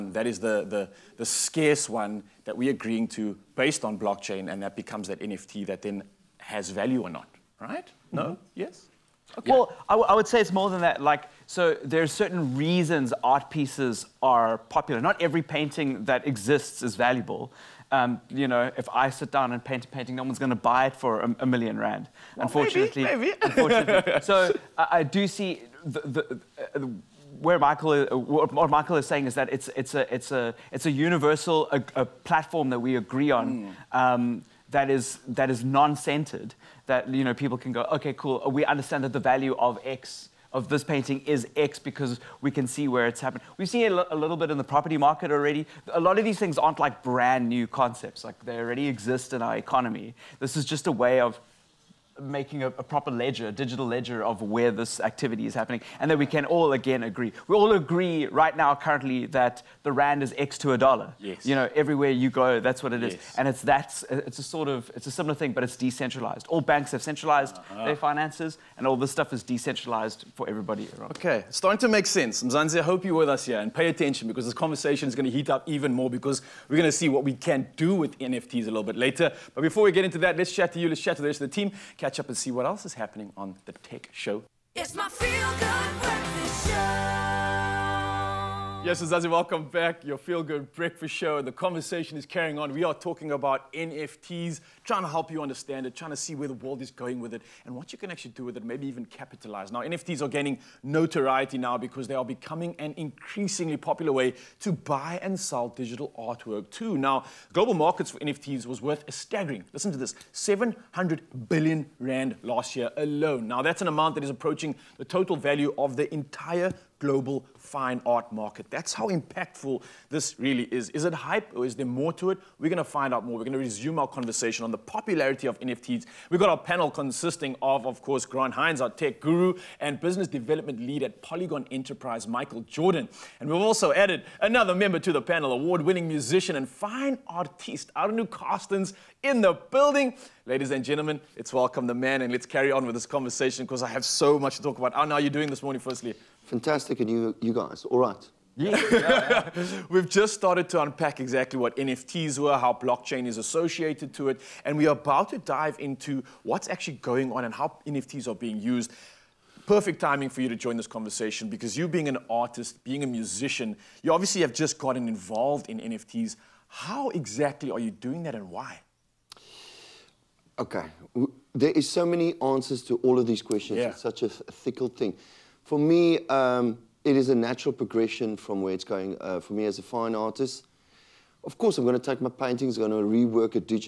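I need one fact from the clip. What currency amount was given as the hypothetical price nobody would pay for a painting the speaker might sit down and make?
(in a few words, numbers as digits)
1 million rand.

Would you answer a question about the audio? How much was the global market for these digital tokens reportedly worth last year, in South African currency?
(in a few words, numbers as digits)
700 billion rand.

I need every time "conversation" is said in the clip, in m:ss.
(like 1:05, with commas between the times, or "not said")
1:14, 1:31, 2:04, 2:23, 2:40.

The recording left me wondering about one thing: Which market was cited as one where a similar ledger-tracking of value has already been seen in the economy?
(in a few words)
property market.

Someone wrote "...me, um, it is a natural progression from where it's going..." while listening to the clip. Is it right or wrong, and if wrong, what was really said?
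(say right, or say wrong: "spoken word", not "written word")
right.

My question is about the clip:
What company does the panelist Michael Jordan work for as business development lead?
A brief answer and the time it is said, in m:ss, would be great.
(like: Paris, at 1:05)
Polygon Enterprise, at 2:11.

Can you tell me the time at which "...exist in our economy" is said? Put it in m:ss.
0:48.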